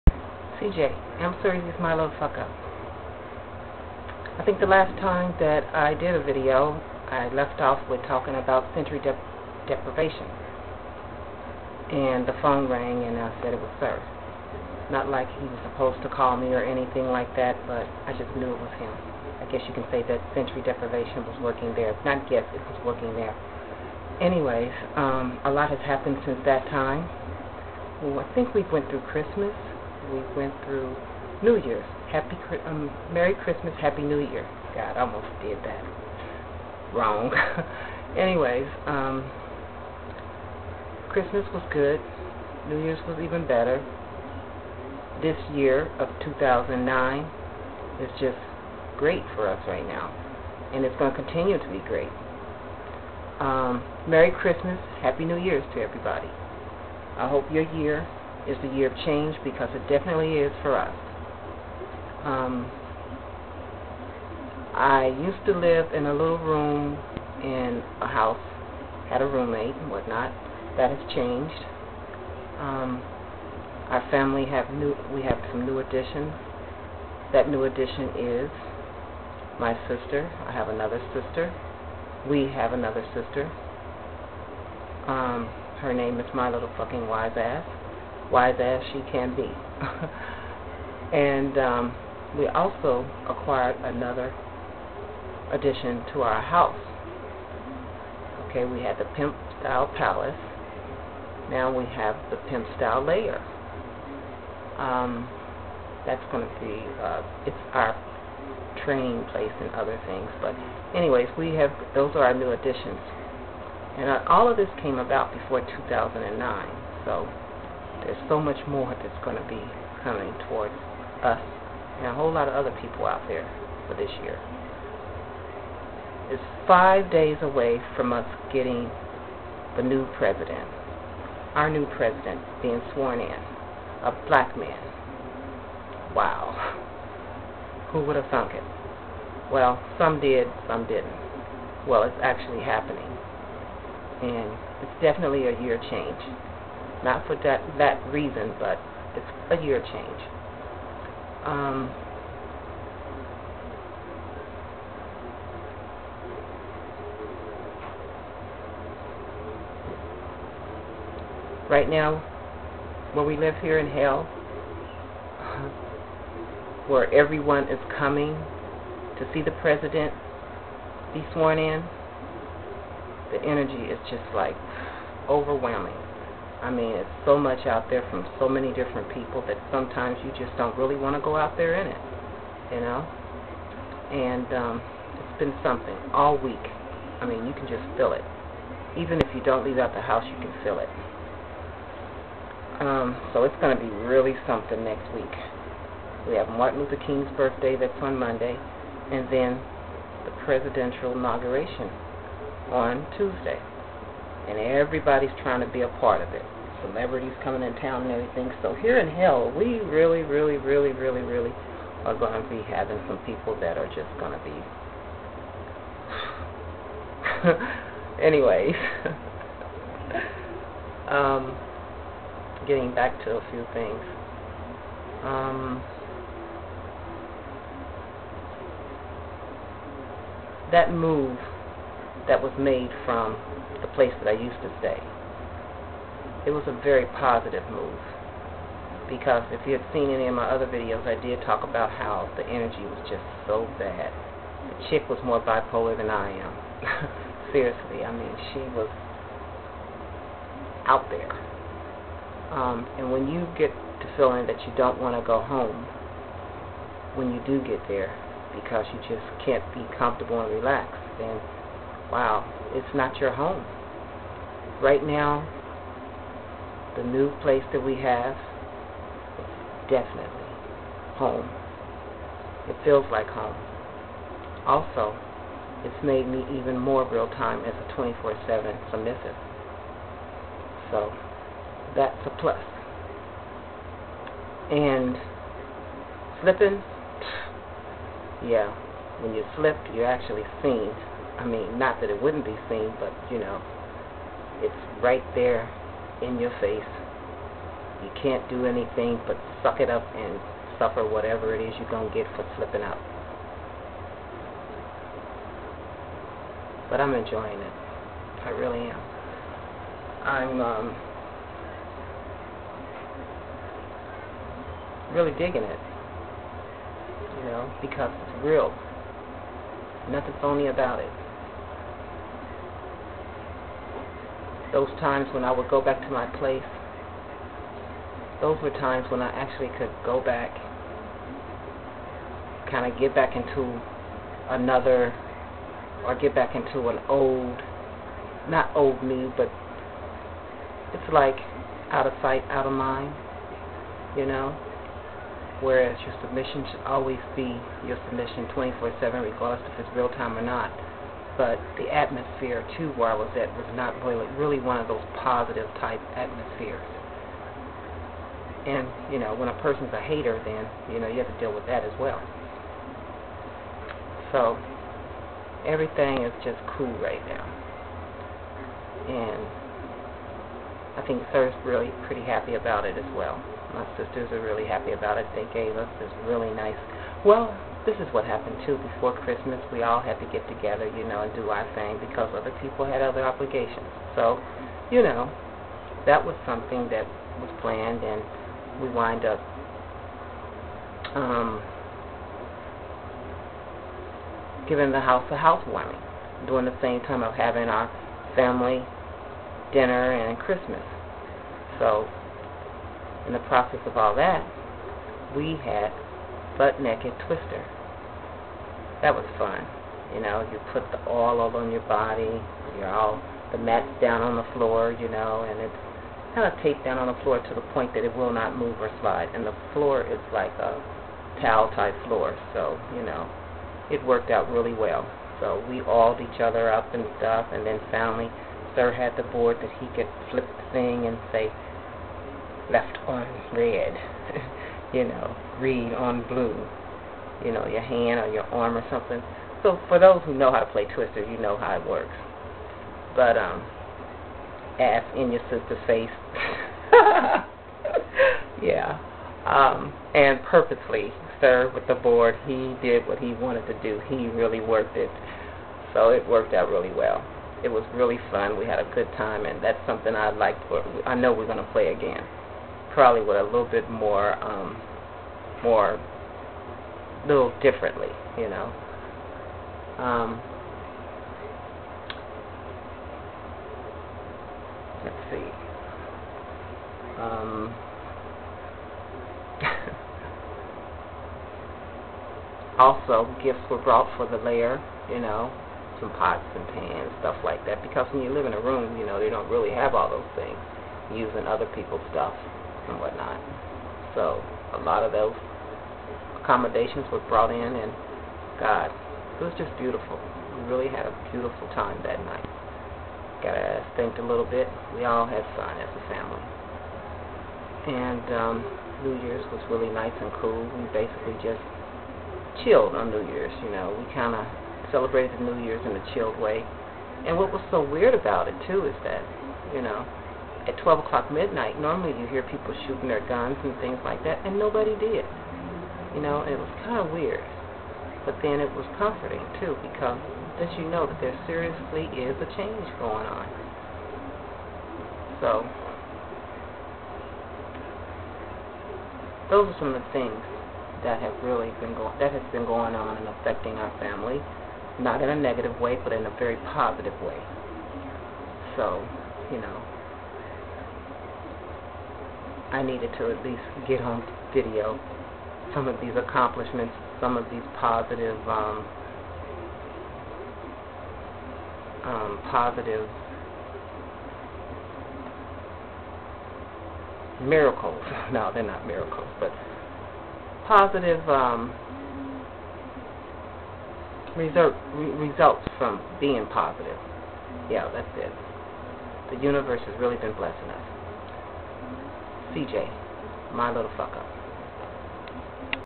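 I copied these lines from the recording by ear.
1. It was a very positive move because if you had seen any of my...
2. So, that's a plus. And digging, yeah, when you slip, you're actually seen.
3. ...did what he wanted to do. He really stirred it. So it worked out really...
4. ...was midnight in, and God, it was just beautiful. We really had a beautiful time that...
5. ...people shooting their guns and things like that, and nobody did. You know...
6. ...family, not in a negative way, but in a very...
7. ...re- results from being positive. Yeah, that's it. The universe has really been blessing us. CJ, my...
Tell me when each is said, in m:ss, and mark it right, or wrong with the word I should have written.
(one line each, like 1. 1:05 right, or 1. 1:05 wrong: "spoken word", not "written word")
1. 3:56 right
2. 4:40 wrong: "slipping", not "digging"
3. 7:32 wrong: "worked", not "stirred"
4. 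8:17 wrong: "brought", not "midnight"
5. 8:42 right
6. 9:03 right
7. 9:34 right.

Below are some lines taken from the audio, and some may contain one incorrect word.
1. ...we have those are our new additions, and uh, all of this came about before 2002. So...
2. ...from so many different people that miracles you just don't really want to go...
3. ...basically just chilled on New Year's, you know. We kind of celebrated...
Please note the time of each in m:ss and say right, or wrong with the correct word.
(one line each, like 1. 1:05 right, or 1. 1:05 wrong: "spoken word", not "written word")
1. 1:51 wrong: "2009", not "2002"
2. 2:58 wrong: "sometimes", not "miracles"
3. 8:30 right.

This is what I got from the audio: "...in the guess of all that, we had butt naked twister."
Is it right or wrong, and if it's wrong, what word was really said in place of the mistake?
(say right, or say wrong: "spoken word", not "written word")
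wrong: "process", not "guess".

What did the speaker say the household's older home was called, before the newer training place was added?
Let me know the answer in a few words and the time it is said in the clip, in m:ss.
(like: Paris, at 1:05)
pimp style palace, at 1:39.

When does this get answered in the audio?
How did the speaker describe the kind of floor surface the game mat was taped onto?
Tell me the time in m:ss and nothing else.
7:01.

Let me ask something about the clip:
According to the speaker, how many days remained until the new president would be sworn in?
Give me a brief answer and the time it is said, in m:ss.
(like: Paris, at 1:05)
5, at 2:06.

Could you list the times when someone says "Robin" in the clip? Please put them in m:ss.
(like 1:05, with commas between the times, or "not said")
not said.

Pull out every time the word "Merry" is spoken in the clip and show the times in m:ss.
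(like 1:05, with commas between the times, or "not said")
0:33, 0:54.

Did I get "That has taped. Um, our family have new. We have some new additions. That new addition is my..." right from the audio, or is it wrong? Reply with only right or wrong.
wrong.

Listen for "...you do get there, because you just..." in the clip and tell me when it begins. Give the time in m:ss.
4:17.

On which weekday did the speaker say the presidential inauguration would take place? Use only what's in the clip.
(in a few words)
Tuesday.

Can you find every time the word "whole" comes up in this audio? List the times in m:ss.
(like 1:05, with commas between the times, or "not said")
2:02.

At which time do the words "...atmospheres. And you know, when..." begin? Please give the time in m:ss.
5:56.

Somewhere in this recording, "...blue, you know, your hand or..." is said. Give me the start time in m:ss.
7:16.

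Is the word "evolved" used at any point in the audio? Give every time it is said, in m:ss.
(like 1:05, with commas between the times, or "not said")
not said.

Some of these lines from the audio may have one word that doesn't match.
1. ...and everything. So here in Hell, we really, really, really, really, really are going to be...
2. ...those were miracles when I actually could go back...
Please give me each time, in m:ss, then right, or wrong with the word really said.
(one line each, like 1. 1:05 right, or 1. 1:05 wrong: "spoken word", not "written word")
1. 3:28 right
2. 5:28 wrong: "times", not "miracles".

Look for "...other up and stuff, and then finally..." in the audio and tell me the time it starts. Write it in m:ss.
7:06.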